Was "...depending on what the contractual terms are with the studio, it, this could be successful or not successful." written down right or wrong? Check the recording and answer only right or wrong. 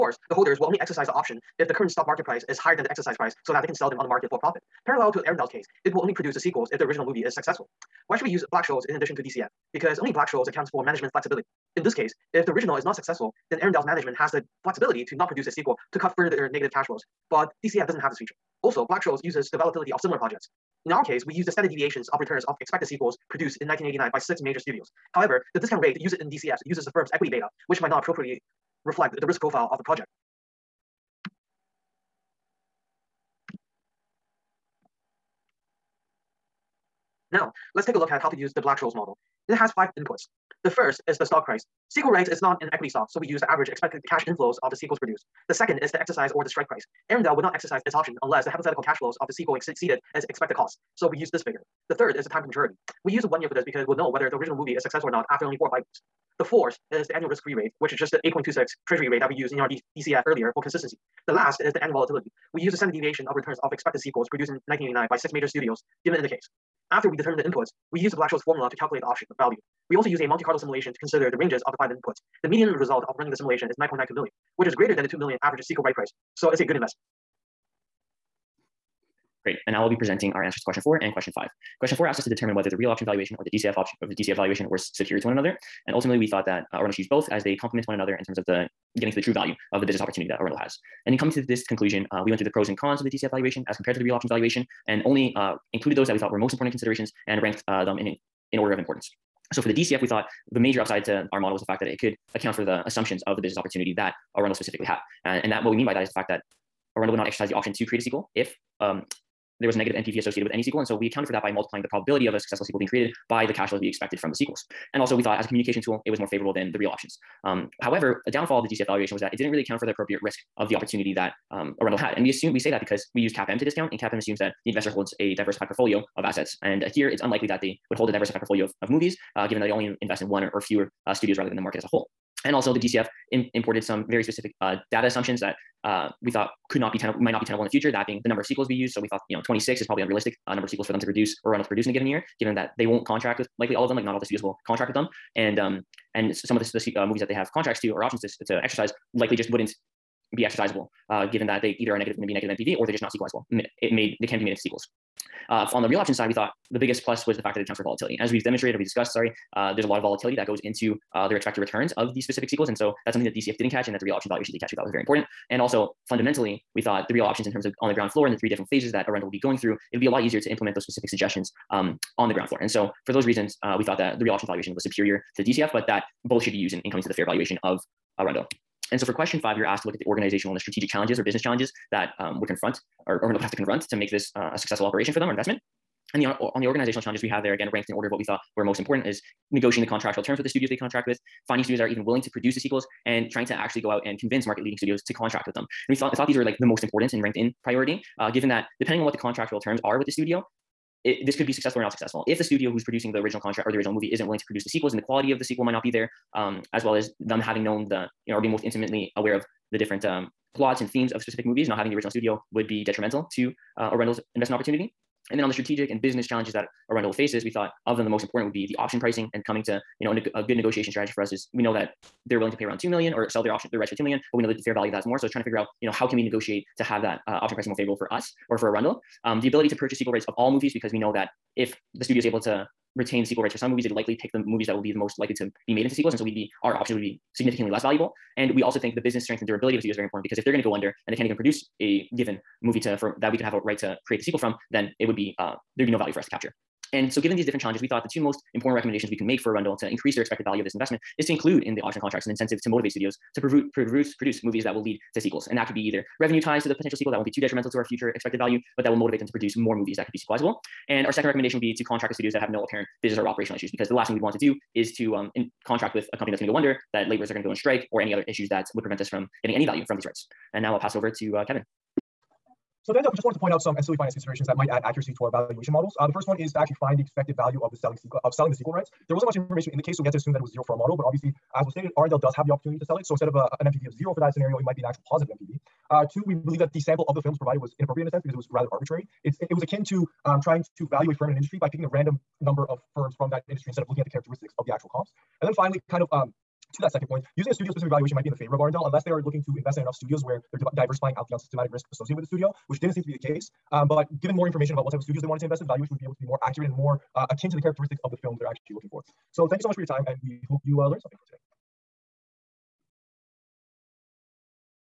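right.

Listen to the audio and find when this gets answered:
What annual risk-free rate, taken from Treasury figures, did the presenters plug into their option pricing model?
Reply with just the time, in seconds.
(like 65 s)
58 s.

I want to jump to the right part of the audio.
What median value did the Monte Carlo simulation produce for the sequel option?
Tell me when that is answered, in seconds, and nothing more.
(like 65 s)
73 s.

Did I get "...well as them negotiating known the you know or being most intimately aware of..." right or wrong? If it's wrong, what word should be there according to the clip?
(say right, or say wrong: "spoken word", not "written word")
wrong: "having", not "negotiating".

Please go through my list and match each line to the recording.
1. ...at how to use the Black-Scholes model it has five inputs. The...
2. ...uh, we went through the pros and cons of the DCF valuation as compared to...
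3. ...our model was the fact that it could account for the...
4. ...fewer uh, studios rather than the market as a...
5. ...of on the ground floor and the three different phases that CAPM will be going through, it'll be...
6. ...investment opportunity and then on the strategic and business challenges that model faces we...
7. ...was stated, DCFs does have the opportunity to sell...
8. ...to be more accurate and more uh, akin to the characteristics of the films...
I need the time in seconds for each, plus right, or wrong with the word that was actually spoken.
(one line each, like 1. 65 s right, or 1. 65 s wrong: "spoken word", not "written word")
1. 38 s right
2. 92 s right
3. 101 s right
4. 130 s right
5. 167 s wrong: "Arundel", not "CAPM"
6. 214 s wrong: "arundel", not "model"
7. 281 s wrong: "Arundel", not "DCFs"
8. 306 s right.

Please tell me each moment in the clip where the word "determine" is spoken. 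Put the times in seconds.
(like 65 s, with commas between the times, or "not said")
67 s, 82 s.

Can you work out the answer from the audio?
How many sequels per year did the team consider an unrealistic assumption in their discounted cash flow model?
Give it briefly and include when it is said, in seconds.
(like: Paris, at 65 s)
26, at 139 s.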